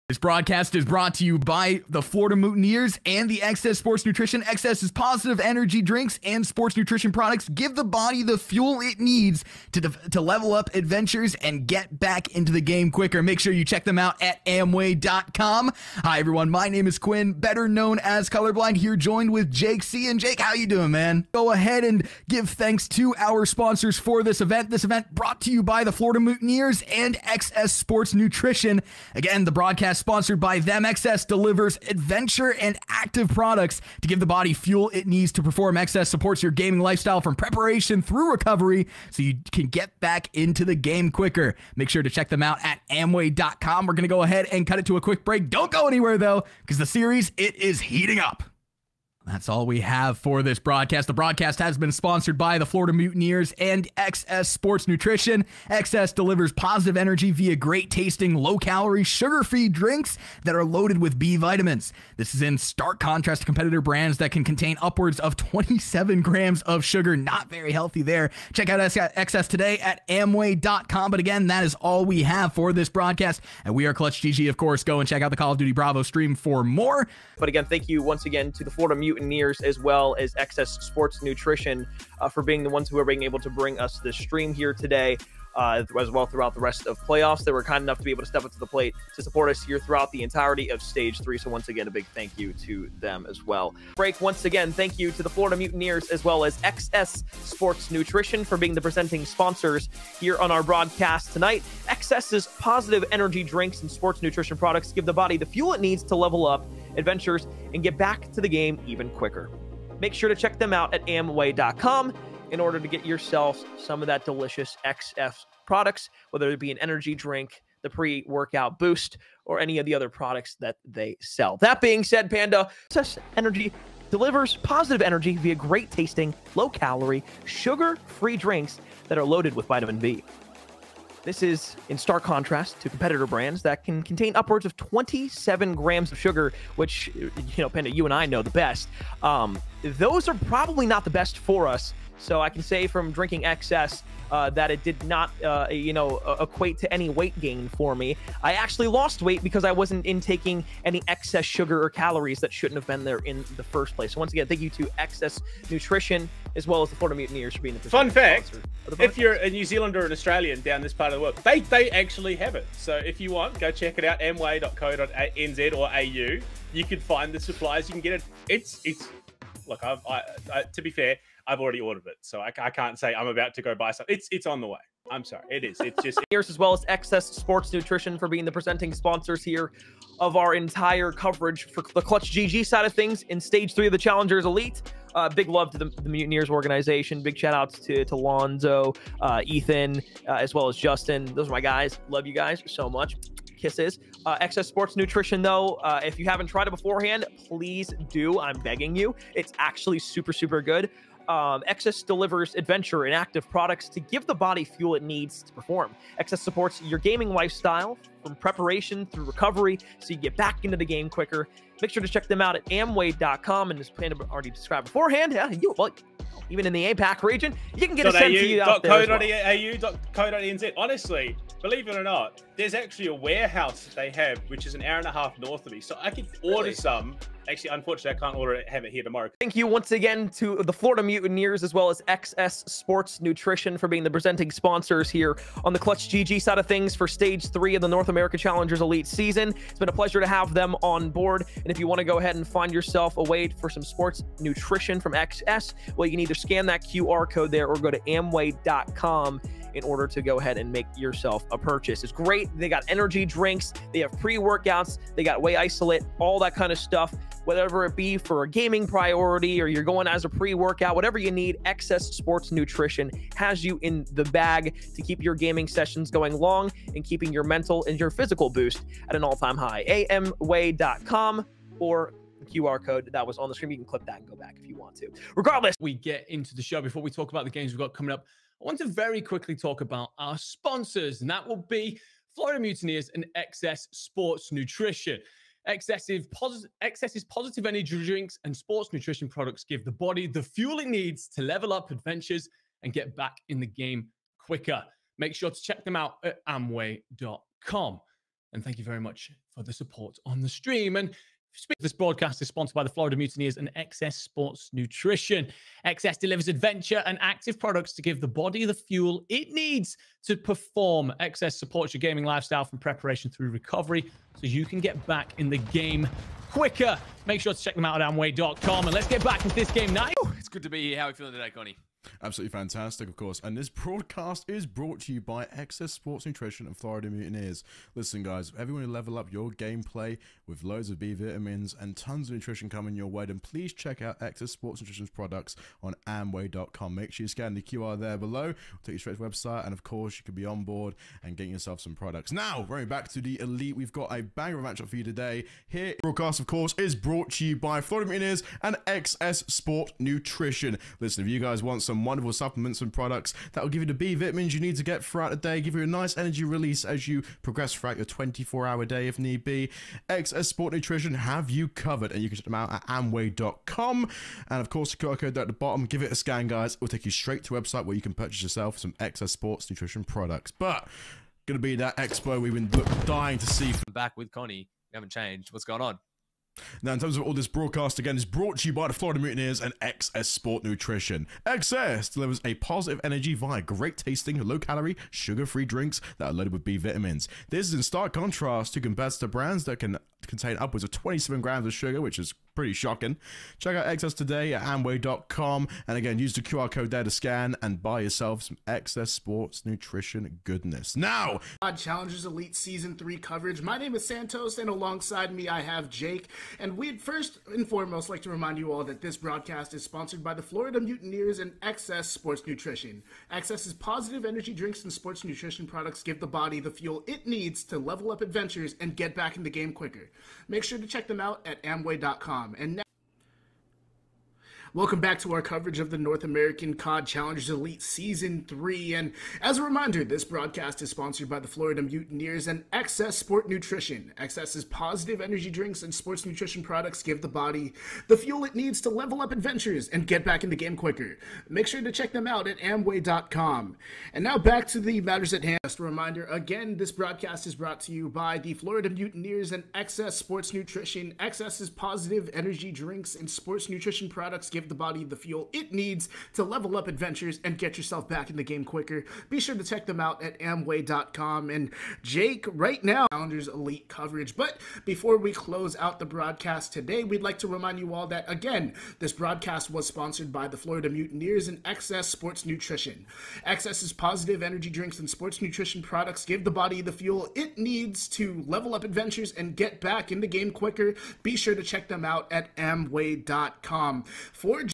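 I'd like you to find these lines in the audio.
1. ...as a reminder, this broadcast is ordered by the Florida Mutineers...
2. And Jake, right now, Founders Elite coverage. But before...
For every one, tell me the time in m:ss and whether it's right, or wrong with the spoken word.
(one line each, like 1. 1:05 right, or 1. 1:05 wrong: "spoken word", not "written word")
1. 7:09 wrong: "sponsored", not "ordered"
2. 7:41 right.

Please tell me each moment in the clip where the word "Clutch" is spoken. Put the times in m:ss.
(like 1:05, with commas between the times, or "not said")
1:13, 3:02, 3:55.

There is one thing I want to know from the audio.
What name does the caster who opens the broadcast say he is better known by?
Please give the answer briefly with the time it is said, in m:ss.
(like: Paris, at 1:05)
Colorblind, at 0:18.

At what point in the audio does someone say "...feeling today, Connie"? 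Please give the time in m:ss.
5:21.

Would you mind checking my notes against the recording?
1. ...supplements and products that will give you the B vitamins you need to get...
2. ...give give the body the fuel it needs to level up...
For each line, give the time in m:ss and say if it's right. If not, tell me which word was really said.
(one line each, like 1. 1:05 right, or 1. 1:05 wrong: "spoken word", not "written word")
1. 5:52 right
2. 7:34 right.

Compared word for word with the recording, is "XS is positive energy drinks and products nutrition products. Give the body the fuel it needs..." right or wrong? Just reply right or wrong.
wrong.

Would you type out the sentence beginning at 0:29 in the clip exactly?
Again, the broadcast sponsored by them.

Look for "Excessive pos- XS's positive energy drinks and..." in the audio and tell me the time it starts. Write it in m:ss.
4:45.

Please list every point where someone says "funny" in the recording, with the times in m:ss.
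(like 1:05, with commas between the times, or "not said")
not said.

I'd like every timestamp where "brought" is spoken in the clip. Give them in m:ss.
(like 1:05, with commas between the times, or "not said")
0:00, 0:25, 5:24, 5:46, 6:18, 7:27.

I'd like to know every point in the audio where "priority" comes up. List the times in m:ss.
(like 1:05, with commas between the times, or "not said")
4:18.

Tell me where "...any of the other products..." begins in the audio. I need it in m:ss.
1:59.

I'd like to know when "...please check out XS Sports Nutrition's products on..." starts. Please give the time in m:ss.
5:33.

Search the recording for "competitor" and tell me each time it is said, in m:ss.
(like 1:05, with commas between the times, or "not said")
1:03, 2:12, 6:28.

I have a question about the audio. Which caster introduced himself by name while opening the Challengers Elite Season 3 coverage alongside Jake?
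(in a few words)
Santos.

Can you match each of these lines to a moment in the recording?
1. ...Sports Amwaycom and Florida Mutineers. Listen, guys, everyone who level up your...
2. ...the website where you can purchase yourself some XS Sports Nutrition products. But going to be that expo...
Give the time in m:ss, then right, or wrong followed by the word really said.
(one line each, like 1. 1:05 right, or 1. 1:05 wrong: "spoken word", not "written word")
1. 5:25 wrong: "Nutrition", not "Amwaycom"
2. 6:07 right.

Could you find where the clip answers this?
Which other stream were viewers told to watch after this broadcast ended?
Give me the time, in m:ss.
1:15.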